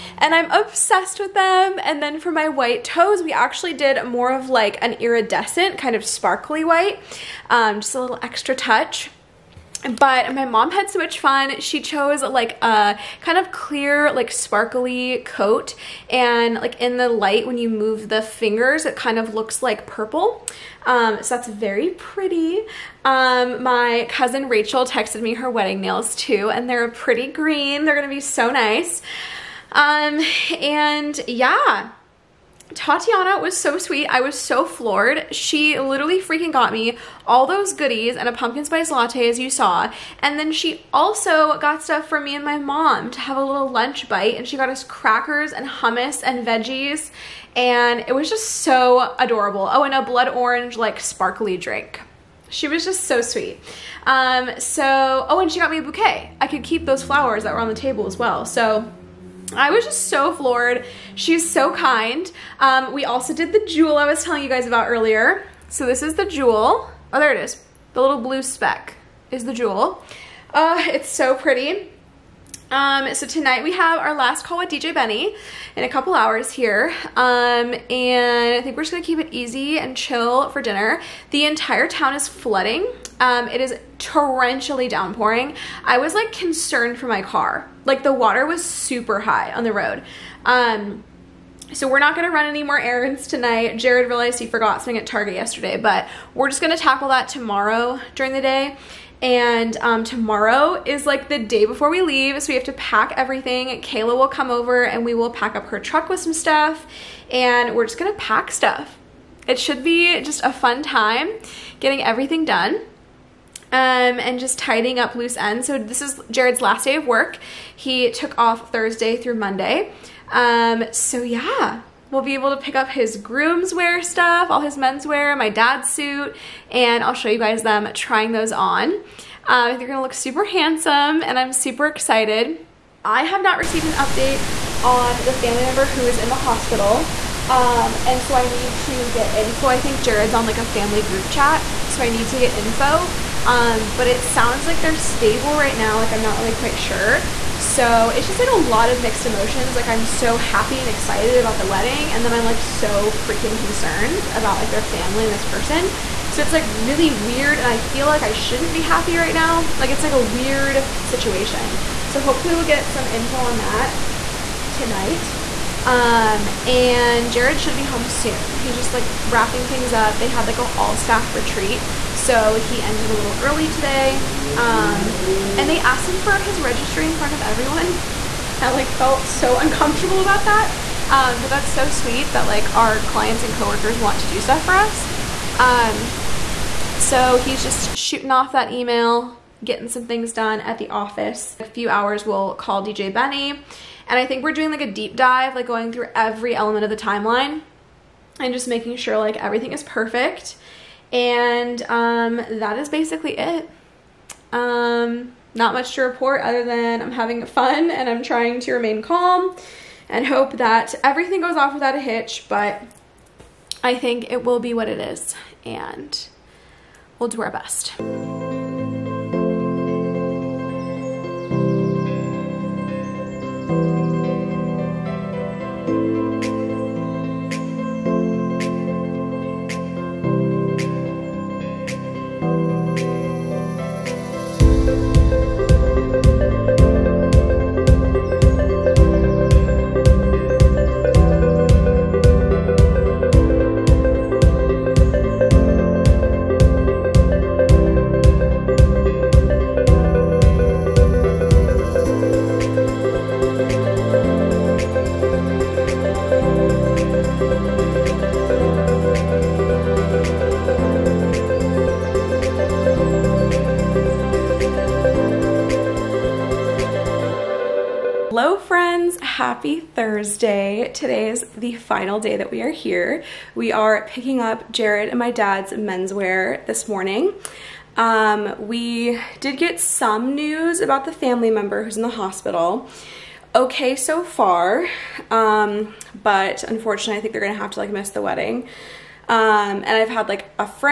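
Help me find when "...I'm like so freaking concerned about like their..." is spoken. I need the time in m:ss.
2:32.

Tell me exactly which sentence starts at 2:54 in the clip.
Um, and they asked him for his registry in front of everyone.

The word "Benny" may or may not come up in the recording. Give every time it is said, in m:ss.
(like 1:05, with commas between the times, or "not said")
1:14, 3:13.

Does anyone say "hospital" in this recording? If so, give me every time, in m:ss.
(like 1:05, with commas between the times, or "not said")
2:16, 4:42.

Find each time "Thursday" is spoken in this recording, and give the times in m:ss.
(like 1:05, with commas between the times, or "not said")
1:58, 4:29.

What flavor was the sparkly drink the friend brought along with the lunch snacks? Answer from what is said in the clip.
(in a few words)
Blood orange.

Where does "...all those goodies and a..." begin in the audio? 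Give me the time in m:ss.
0:37.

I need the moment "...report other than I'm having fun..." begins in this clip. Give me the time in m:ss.
3:26.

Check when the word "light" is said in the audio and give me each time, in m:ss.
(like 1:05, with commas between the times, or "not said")
0:17.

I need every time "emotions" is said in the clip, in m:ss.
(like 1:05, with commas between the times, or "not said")
2:29.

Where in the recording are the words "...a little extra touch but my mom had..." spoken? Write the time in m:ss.
0:07.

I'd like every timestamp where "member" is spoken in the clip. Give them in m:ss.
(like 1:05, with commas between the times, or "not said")
2:15, 4:41.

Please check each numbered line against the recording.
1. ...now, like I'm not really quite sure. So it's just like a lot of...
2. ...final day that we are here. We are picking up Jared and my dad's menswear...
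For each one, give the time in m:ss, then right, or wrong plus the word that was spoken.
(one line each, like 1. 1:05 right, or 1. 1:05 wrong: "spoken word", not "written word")
1. 2:25 right
2. 4:31 right.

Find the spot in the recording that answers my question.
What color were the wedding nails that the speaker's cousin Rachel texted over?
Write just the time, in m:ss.
0:27.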